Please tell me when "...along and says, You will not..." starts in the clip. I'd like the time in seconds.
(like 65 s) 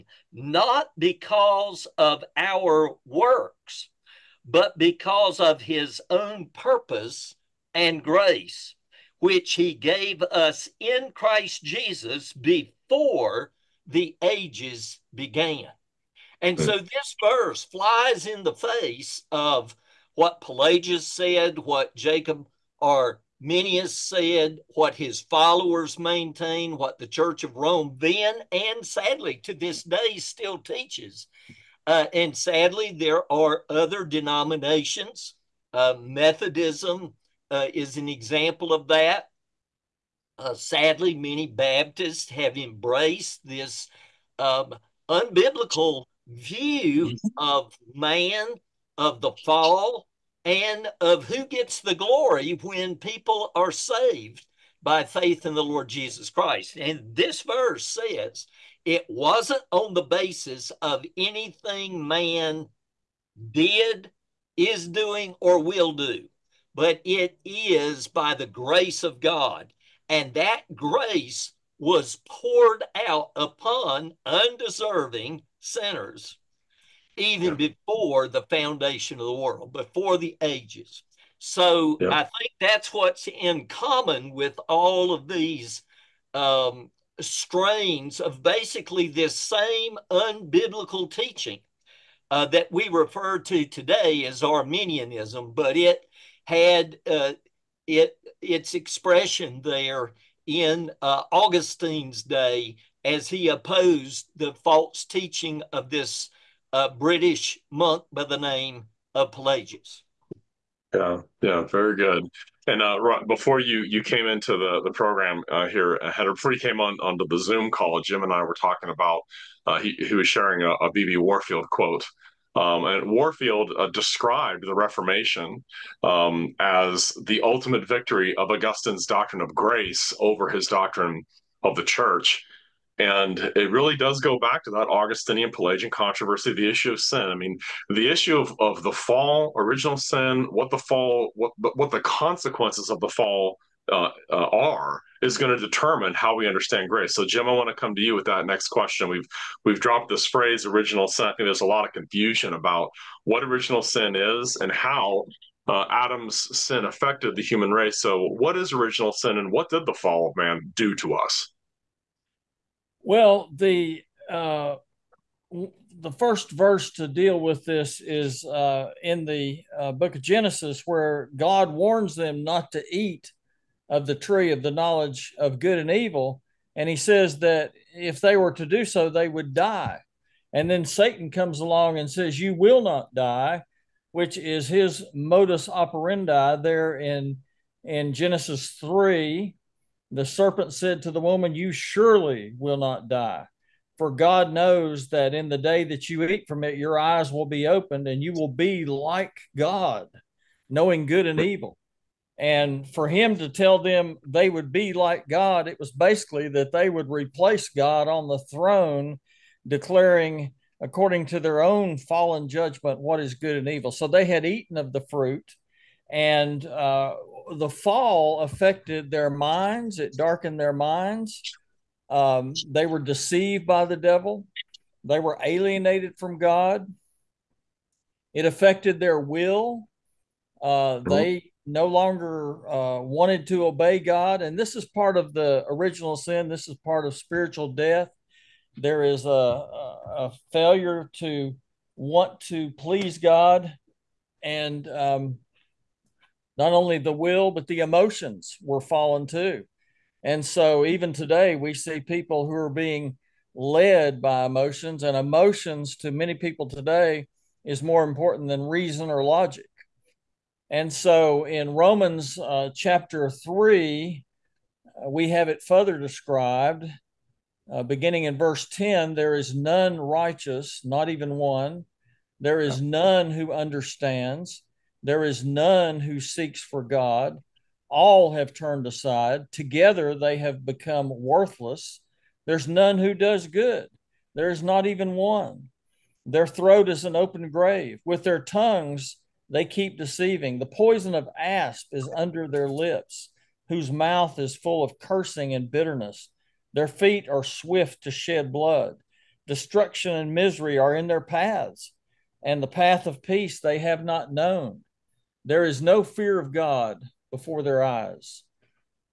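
181 s.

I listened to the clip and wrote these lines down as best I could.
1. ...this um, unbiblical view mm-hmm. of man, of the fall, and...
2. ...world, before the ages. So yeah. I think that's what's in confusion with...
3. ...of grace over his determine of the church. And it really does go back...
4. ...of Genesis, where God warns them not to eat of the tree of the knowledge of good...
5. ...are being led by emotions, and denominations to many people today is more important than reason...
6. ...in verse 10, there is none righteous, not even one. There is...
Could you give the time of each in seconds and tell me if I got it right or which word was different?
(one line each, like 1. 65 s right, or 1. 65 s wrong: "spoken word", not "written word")
1. 43 s right
2. 79 s wrong: "common", not "confusion"
3. 129 s wrong: "doctrine", not "determine"
4. 170 s right
5. 252 s wrong: "emotions", not "denominations"
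6. 268 s right.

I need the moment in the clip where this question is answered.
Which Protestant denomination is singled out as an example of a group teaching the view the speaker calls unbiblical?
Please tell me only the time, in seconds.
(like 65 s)
35 s.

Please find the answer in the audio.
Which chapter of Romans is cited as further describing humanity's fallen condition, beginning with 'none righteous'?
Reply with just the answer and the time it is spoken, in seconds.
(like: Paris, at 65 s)
Chapter 3, at 262 s.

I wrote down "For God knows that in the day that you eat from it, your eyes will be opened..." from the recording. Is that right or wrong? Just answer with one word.
right.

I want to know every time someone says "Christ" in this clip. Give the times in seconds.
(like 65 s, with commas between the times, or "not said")
11 s, 56 s.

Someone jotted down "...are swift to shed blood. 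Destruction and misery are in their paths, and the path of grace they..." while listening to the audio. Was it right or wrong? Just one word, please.
wrong.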